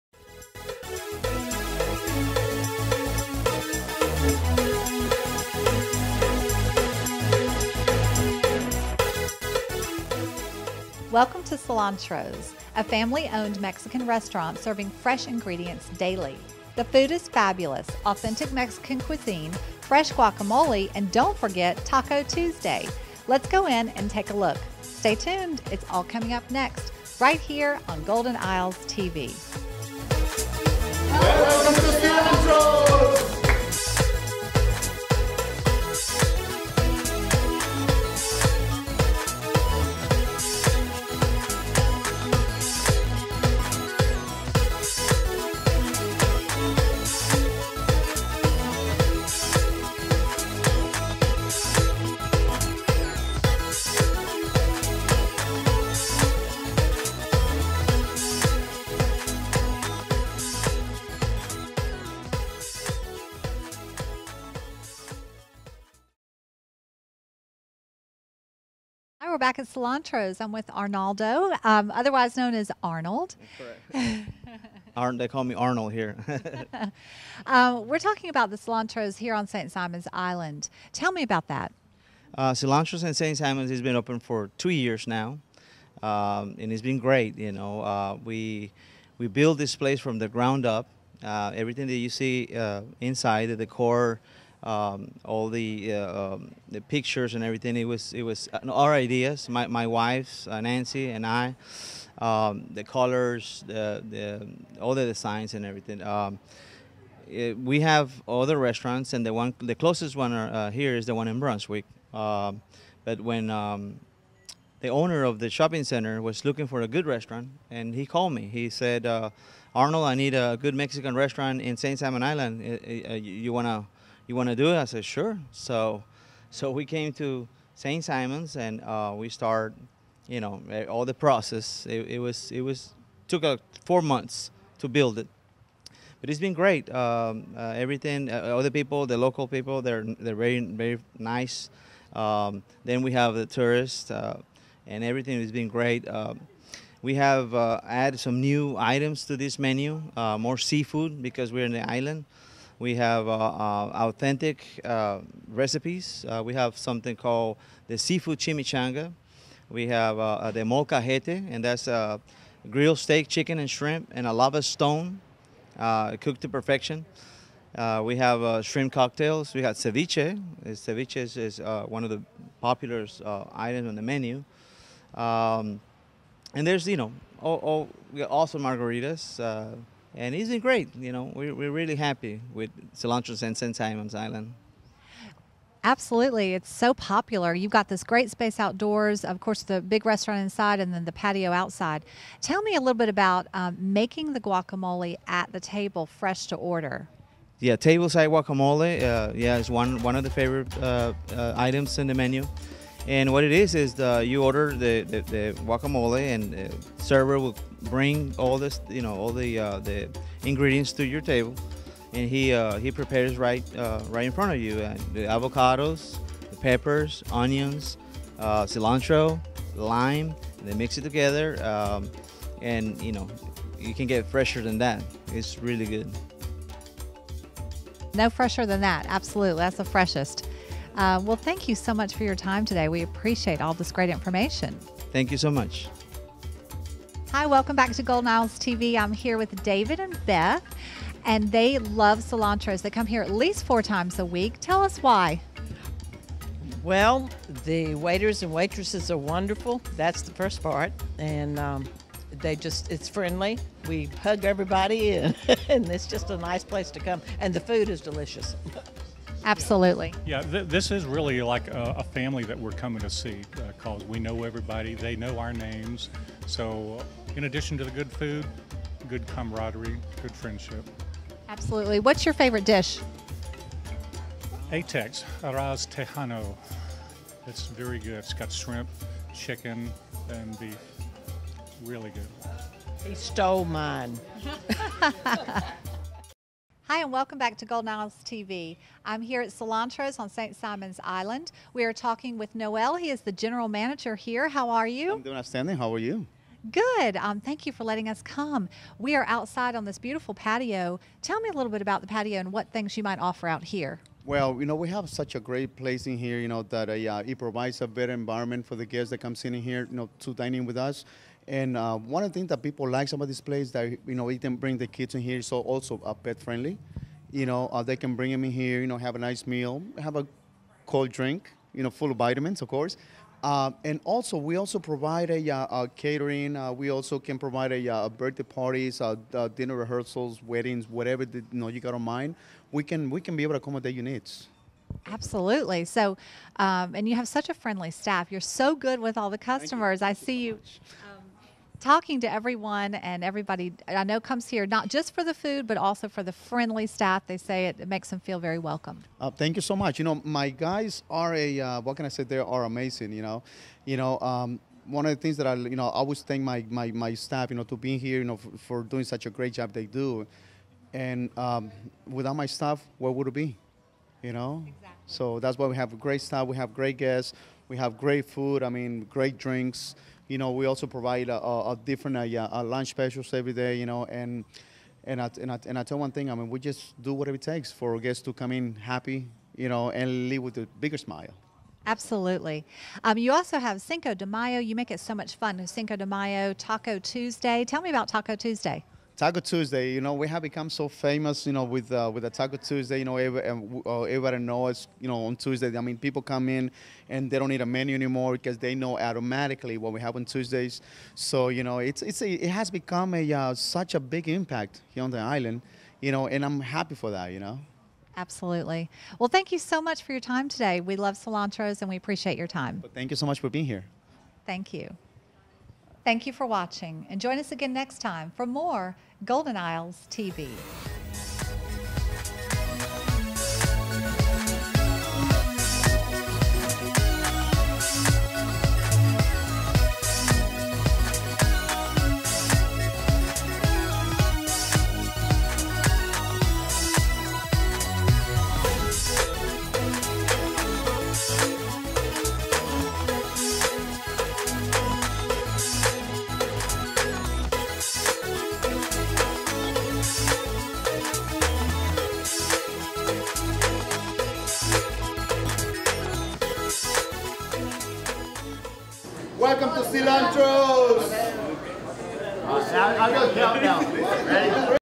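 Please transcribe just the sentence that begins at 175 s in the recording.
Um, and there's, you know, all, all, awesome margaritas and it's been great.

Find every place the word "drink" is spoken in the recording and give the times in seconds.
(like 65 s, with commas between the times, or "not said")
321 s, 369 s.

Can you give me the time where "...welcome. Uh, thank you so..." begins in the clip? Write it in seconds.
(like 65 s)
348 s.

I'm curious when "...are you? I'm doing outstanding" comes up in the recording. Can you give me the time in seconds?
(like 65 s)
294 s.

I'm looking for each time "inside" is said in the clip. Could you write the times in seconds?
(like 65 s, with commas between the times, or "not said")
92 s, 190 s.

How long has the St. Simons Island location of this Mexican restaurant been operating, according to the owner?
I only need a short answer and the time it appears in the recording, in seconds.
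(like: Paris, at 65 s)
2 years, at 84 s.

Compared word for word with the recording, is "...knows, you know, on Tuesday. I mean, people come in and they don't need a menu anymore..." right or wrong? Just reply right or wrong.
right.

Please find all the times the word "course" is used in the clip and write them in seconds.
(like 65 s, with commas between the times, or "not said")
189 s, 322 s.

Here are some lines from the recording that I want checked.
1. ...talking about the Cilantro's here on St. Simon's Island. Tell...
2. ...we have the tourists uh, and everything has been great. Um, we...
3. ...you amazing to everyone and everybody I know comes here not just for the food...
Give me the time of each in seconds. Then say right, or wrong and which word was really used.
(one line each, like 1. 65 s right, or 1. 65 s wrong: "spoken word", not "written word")
1. 77 s right
2. 143 s right
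3. 340 s wrong: "talking", not "amazing".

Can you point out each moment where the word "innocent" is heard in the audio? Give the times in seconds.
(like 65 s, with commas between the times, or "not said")
not said.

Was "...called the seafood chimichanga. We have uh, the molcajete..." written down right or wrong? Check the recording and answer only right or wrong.
right.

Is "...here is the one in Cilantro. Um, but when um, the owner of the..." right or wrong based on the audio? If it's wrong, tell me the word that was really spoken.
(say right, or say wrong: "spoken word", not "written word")
wrong: "Brunswick", not "Cilantro".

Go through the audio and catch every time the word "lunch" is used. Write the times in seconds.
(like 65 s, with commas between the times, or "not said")
372 s.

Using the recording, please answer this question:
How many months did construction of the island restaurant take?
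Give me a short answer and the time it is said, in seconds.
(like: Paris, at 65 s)
4 months, at 133 s.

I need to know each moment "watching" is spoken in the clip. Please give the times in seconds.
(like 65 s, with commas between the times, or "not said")
416 s.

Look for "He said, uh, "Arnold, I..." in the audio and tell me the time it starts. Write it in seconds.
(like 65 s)
118 s.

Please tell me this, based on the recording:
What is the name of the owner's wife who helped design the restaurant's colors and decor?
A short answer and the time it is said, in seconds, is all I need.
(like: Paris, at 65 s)
Nancy, at 100 s.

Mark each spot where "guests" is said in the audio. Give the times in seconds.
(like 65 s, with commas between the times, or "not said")
308 s, 366 s, 377 s.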